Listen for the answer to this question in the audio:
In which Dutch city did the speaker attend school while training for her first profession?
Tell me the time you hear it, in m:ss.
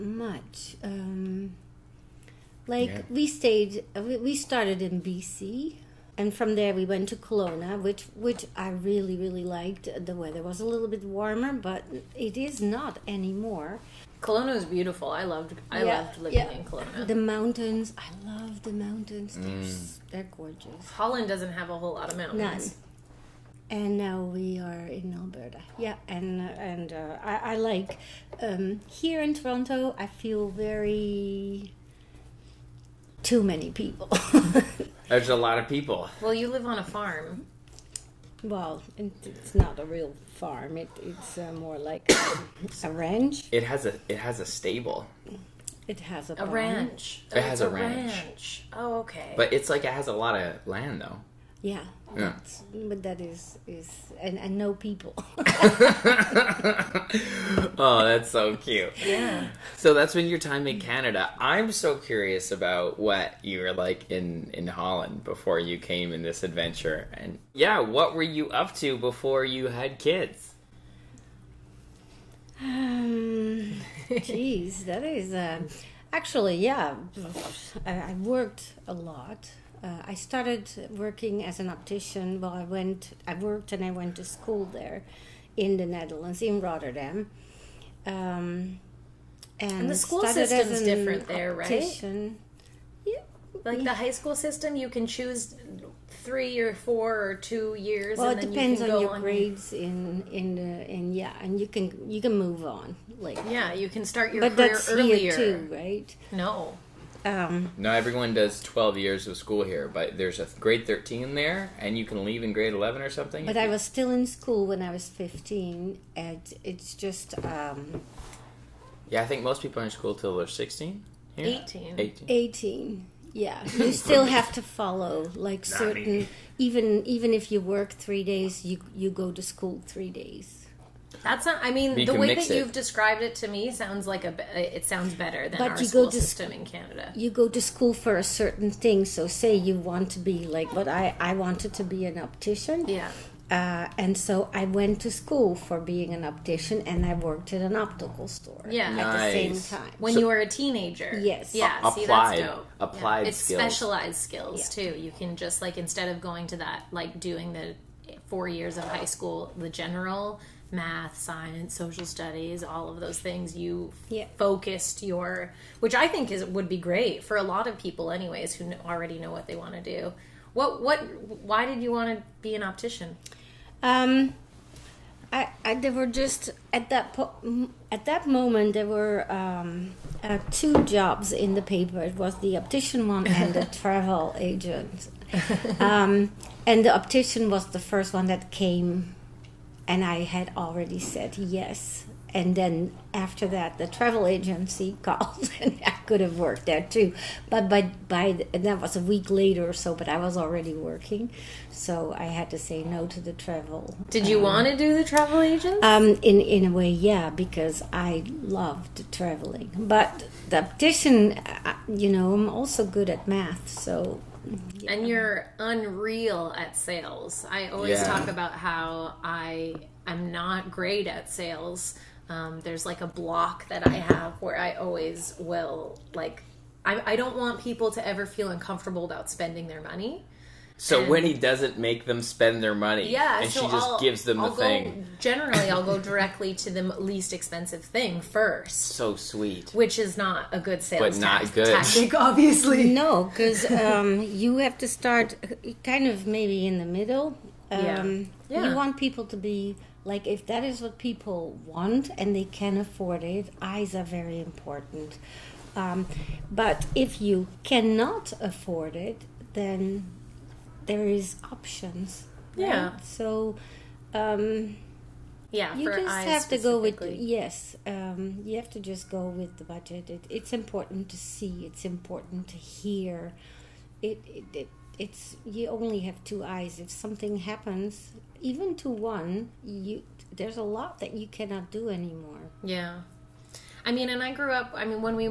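1:26.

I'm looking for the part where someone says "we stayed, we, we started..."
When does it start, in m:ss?
0:03.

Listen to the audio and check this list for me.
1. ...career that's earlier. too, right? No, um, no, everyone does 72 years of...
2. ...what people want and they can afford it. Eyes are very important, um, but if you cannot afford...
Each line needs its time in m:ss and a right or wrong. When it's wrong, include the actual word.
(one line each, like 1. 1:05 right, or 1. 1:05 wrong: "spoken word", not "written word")
1. 1:44 wrong: "12", not "72"
2. 4:10 right.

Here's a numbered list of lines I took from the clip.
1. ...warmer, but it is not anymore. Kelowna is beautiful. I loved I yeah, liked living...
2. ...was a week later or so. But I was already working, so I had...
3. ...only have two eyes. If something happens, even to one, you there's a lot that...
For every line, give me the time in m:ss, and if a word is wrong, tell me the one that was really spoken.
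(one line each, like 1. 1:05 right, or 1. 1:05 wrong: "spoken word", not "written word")
1. 0:11 wrong: "loved", not "liked"
2. 3:18 right
3. 4:35 right.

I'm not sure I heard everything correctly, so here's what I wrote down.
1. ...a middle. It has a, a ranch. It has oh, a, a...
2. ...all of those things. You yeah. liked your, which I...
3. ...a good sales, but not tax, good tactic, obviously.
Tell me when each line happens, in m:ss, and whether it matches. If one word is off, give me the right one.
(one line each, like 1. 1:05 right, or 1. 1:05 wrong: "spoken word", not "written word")
1. 0:44 wrong: "stable", not "middle"
2. 2:42 wrong: "focused", not "liked"
3. 4:00 right.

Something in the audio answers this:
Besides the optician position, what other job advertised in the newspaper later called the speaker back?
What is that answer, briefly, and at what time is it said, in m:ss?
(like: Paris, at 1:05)
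travel agent, at 3:03.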